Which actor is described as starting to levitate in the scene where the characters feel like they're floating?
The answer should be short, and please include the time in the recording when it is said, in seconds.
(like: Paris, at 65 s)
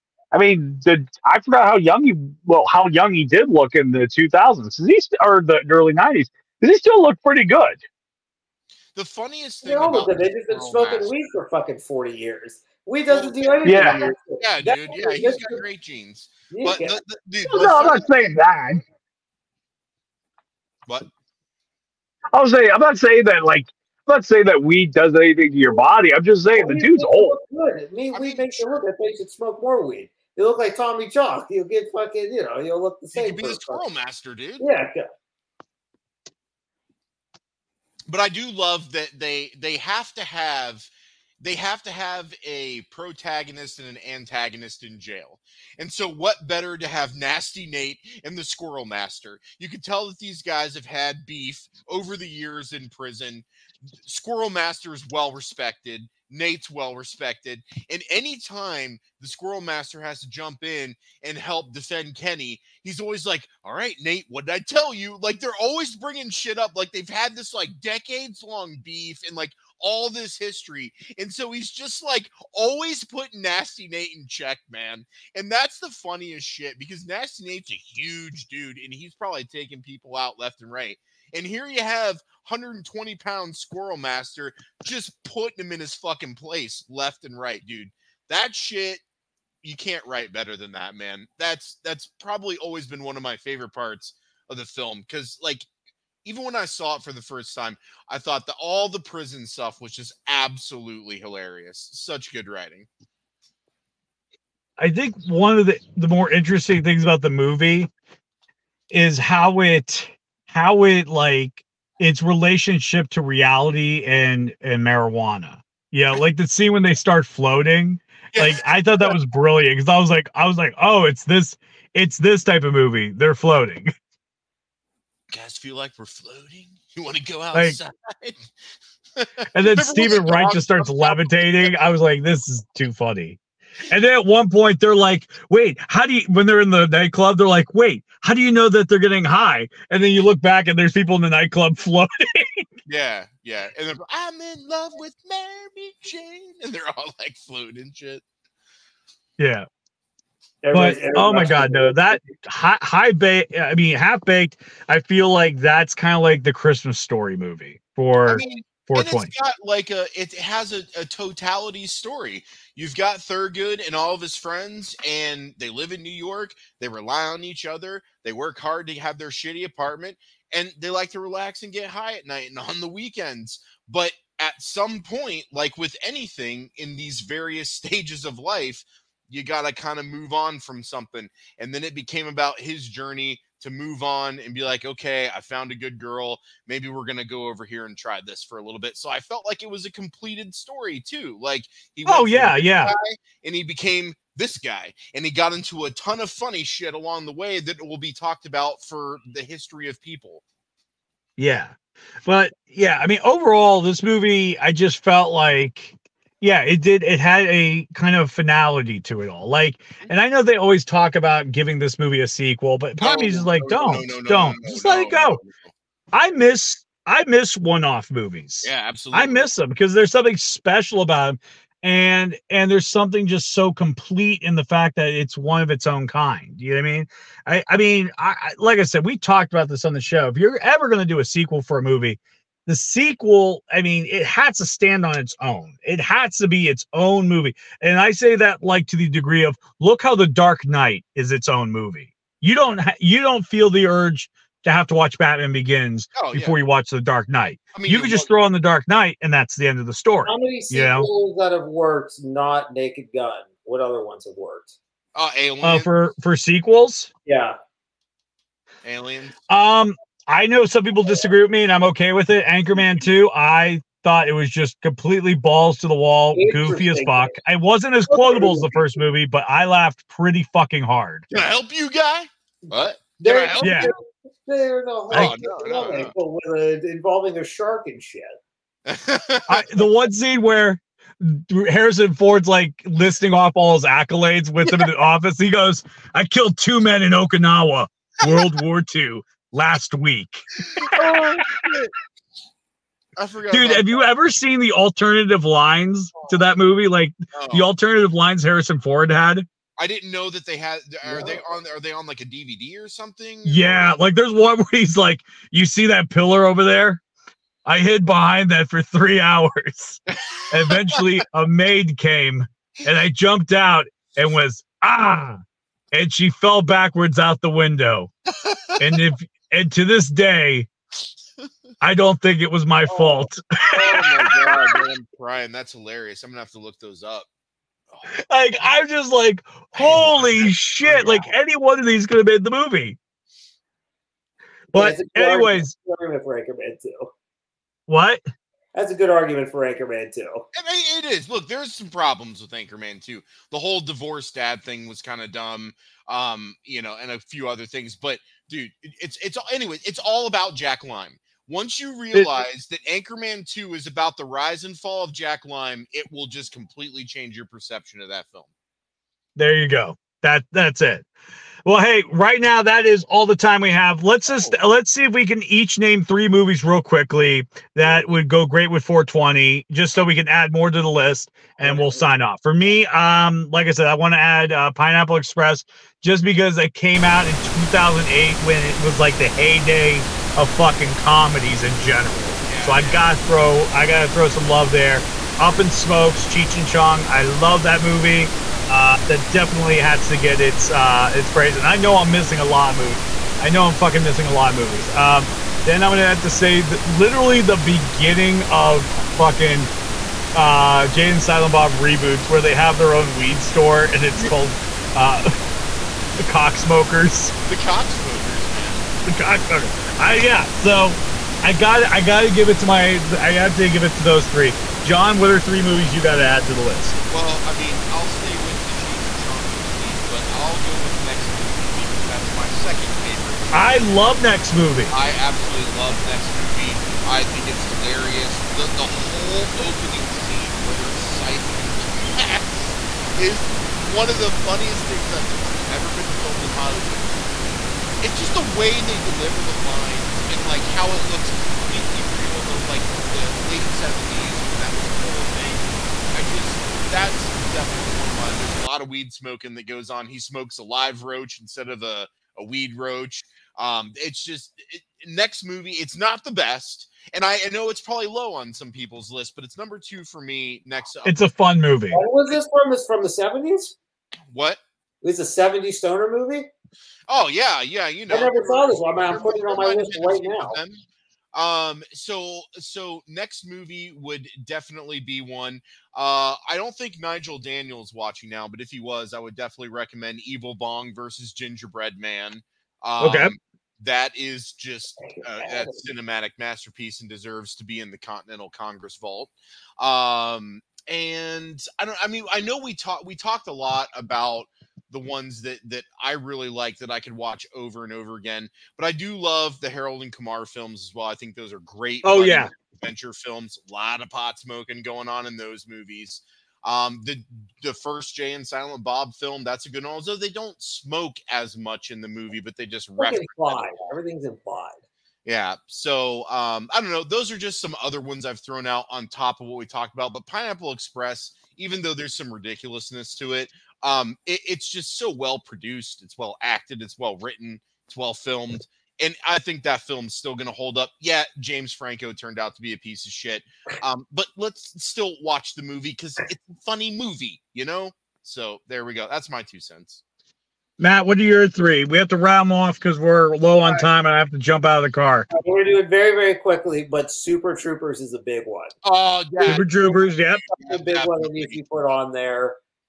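Steven Wright, at 129 s.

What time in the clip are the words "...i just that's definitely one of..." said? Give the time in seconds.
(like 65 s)
446 s.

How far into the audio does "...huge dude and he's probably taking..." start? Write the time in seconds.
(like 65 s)
77 s.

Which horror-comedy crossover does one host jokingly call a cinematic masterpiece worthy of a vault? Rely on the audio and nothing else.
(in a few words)
Evil Bong versus Gingerbread Man.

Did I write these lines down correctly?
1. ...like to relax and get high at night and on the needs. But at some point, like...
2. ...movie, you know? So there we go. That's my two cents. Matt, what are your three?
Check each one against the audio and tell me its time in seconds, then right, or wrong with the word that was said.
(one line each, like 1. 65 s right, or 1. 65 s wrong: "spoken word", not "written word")
1. 170 s wrong: "weekends", not "needs"
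2. 536 s right.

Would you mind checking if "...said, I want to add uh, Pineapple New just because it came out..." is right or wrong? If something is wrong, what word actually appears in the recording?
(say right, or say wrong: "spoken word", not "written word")
wrong: "Express", not "New".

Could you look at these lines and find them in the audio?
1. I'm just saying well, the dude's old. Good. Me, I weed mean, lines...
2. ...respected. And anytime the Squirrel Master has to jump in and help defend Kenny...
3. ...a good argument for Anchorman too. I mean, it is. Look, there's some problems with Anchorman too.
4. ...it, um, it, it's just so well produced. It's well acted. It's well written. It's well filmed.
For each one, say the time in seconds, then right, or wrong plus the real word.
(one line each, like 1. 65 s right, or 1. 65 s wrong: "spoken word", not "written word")
1. 26 s wrong: "makes", not "lines"
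2. 56 s right
3. 338 s right
4. 523 s right.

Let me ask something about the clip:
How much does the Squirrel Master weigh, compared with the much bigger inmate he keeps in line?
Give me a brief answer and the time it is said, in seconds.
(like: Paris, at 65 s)
120 pounds, at 82 s.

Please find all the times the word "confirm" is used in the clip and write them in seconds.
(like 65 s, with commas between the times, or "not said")
not said.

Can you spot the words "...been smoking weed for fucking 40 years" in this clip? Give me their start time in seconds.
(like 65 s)
10 s.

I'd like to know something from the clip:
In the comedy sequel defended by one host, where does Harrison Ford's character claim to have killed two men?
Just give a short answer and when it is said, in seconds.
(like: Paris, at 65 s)
Okinawa, at 287 s.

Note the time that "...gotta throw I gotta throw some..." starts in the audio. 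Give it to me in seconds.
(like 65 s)
382 s.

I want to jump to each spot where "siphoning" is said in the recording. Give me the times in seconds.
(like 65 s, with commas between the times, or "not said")
430 s.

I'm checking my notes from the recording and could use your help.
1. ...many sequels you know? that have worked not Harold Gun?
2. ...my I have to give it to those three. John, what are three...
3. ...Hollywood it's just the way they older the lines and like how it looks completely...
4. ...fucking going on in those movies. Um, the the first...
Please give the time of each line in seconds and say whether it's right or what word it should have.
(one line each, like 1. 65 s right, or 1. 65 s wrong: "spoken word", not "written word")
1. 250 s wrong: "Naked", not "Harold"
2. 412 s right
3. 436 s wrong: "deliver", not "older"
4. 504 s wrong: "smoking", not "fucking".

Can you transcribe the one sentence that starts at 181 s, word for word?
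And then it became about his journey to move on and be like, okay, I found a good girl.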